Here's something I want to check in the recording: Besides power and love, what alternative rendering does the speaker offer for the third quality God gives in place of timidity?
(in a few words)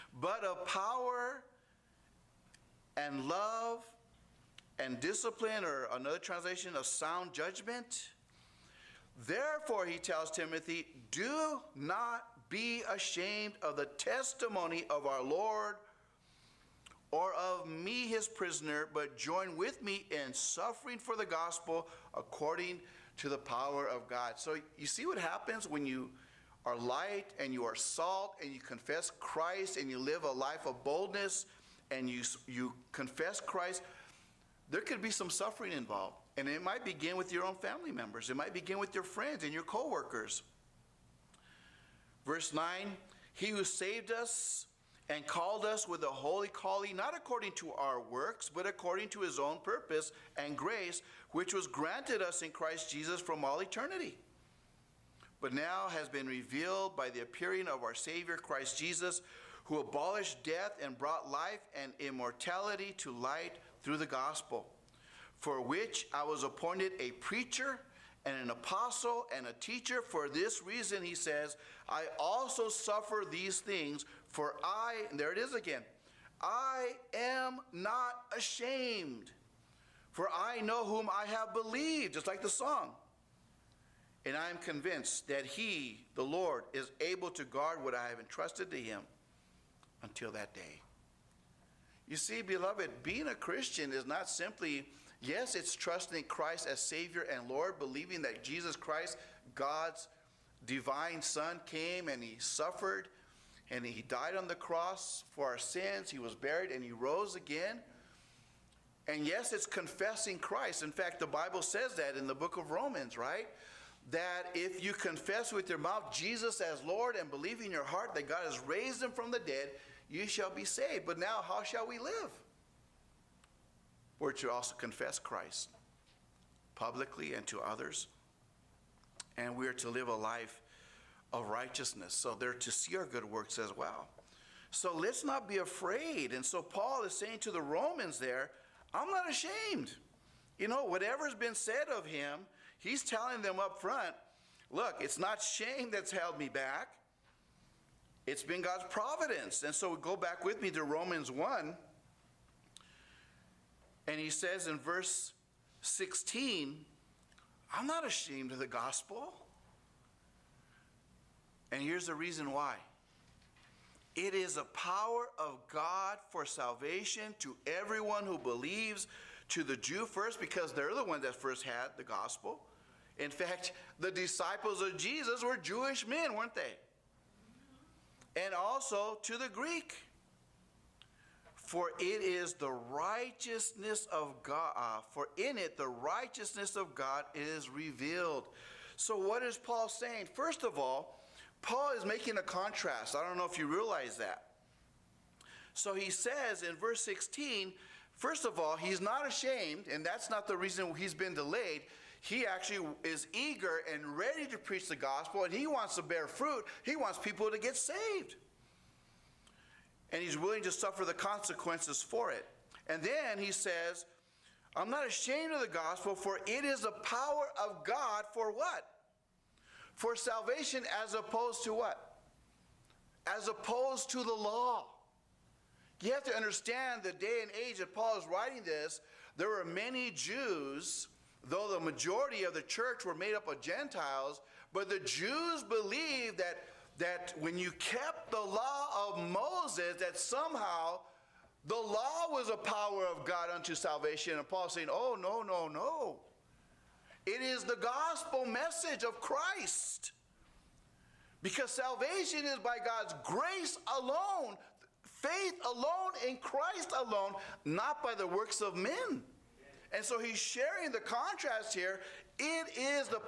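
sound judgment.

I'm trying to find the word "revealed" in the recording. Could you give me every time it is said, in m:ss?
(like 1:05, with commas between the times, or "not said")
0:56, 3:07.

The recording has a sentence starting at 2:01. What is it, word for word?
But now, how shall we live?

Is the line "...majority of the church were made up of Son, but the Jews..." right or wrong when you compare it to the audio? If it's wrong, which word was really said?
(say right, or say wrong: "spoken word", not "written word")
wrong: "Gentiles", not "Son".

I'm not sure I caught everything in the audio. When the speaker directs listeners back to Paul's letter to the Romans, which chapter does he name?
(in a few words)
Romans 1.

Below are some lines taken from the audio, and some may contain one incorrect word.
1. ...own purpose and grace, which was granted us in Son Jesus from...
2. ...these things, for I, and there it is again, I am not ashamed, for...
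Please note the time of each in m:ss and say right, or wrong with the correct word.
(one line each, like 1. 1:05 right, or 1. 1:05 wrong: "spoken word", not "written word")
1. 0:49 wrong: "Christ", not "Son"
2. 1:13 right.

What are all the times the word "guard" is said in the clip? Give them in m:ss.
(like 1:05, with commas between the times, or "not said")
1:27.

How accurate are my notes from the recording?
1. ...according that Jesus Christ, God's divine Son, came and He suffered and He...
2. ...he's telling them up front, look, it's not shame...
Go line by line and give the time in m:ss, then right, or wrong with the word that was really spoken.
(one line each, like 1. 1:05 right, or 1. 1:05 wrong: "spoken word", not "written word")
1. 1:37 wrong: "believing", not "according"
2. 2:22 right.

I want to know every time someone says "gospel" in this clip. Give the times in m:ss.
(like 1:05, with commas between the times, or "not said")
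0:21, 1:04, 2:38, 2:52, 3:24, 3:35, 4:07.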